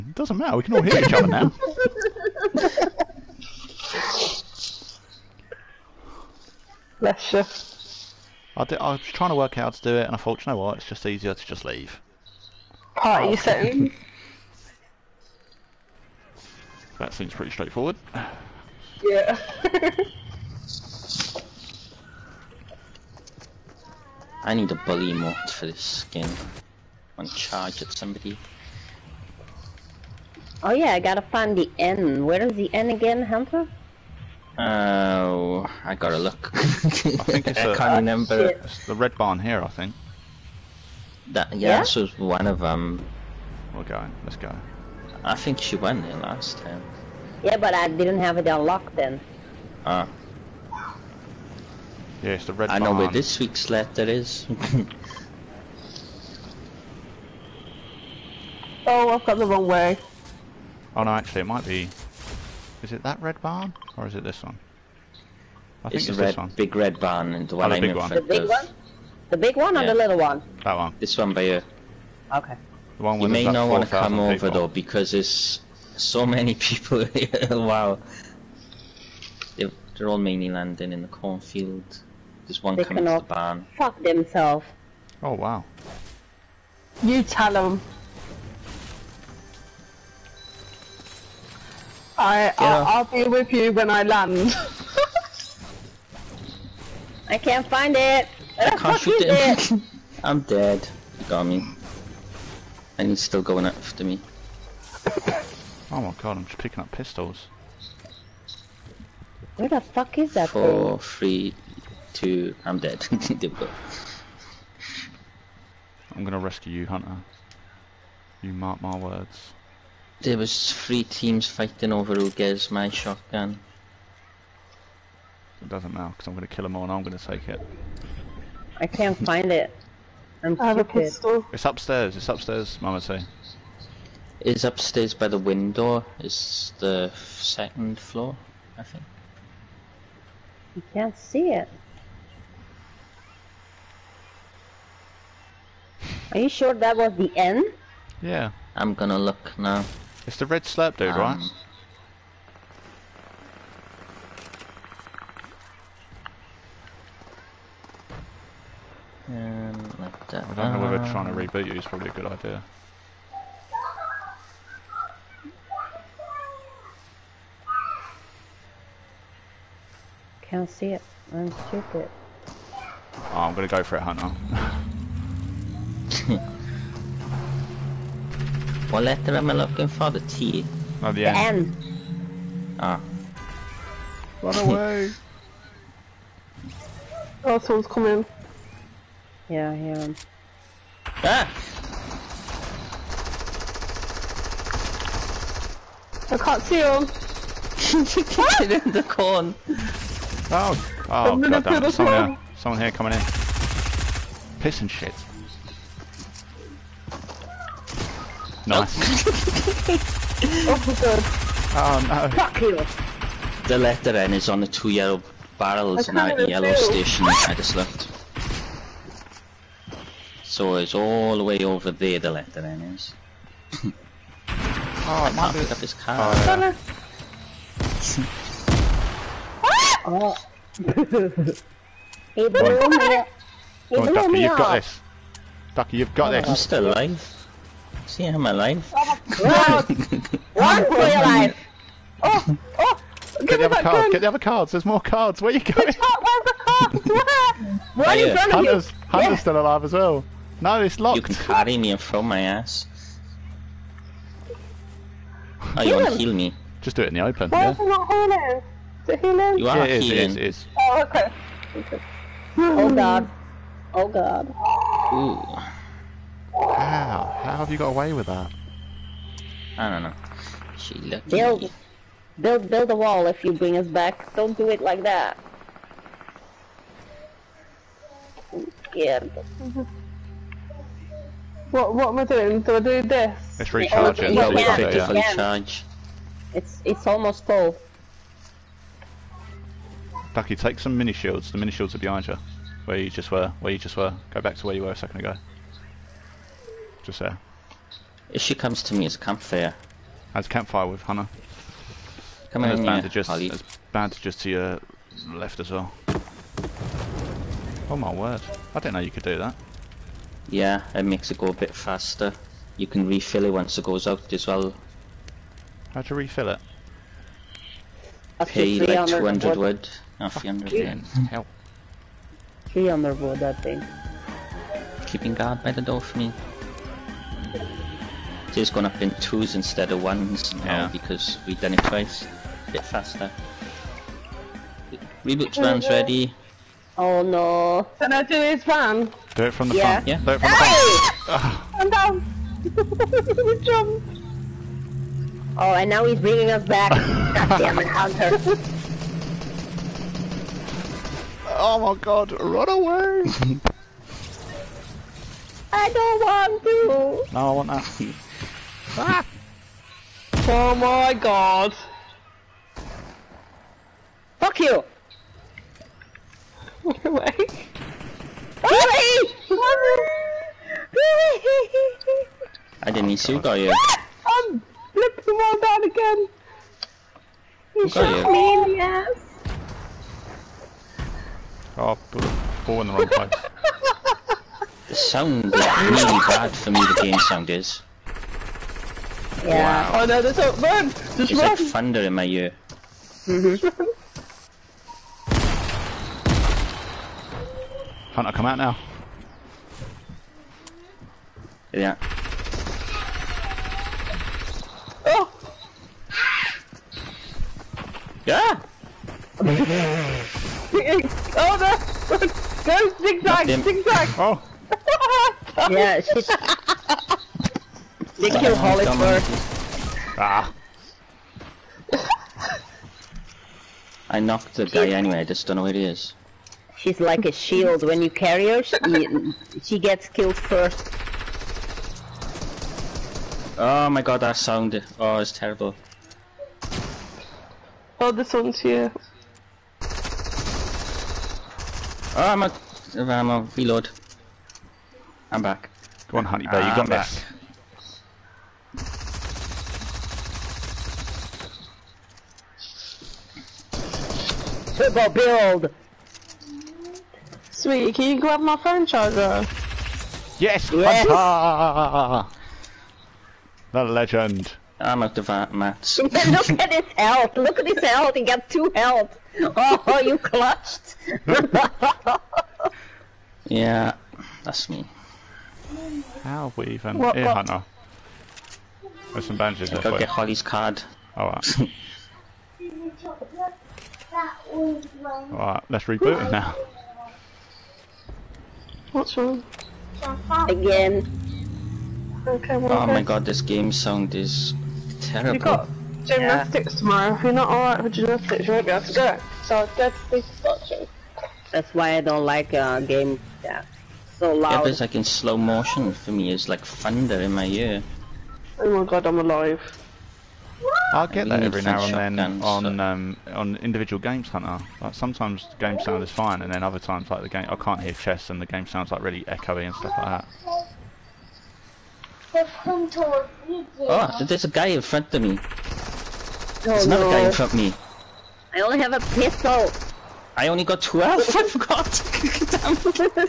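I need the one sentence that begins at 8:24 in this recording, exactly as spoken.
Yeah, it's like in slow motion for me.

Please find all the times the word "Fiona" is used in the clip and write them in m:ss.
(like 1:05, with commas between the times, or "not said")
5:20.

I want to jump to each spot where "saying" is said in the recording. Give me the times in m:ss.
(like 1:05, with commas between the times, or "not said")
0:13.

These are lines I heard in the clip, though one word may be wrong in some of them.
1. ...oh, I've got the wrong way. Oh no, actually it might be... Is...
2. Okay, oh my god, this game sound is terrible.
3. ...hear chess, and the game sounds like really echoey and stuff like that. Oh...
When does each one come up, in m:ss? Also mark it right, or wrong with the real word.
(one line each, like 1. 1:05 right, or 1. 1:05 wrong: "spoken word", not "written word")
1. 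0:58 right
2. 8:12 right
3. 8:37 right.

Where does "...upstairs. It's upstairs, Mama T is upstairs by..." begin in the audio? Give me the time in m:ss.
2:11.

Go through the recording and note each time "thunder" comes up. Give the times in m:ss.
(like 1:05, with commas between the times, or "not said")
6:31, 8:26.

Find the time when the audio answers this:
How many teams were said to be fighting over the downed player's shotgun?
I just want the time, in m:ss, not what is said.
2:00.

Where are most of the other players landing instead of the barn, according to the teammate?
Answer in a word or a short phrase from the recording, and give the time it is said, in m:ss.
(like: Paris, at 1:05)
The cornfield, at 1:21.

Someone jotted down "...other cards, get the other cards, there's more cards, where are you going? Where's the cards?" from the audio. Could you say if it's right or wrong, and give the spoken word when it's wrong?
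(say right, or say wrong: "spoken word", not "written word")
right.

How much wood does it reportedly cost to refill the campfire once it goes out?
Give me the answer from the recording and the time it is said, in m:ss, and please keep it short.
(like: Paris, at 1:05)
200 wood, at 5:19.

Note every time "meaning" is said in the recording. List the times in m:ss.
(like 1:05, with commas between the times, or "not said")
not said.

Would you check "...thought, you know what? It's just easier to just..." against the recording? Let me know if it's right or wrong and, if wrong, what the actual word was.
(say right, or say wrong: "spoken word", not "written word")
right.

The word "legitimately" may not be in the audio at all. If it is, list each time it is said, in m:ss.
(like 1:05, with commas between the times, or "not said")
not said.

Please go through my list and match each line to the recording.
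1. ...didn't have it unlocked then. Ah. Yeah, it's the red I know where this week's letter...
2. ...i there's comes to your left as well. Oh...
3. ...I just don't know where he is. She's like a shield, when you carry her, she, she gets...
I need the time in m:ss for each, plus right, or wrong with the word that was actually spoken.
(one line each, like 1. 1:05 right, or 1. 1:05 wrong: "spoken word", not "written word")
1. 0:47 right
2. 5:03 wrong: "bandages", not "comes"
3. 7:05 right.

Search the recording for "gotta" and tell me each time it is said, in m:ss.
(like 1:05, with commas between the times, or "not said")
0:30, 0:35.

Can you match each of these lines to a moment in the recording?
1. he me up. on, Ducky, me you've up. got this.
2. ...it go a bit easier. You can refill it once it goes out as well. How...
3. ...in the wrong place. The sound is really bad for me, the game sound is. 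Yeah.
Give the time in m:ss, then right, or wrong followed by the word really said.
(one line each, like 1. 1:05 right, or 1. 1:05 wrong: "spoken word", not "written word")
1. 3:50 right
2. 5:11 wrong: "faster", not "easier"
3. 6:22 right.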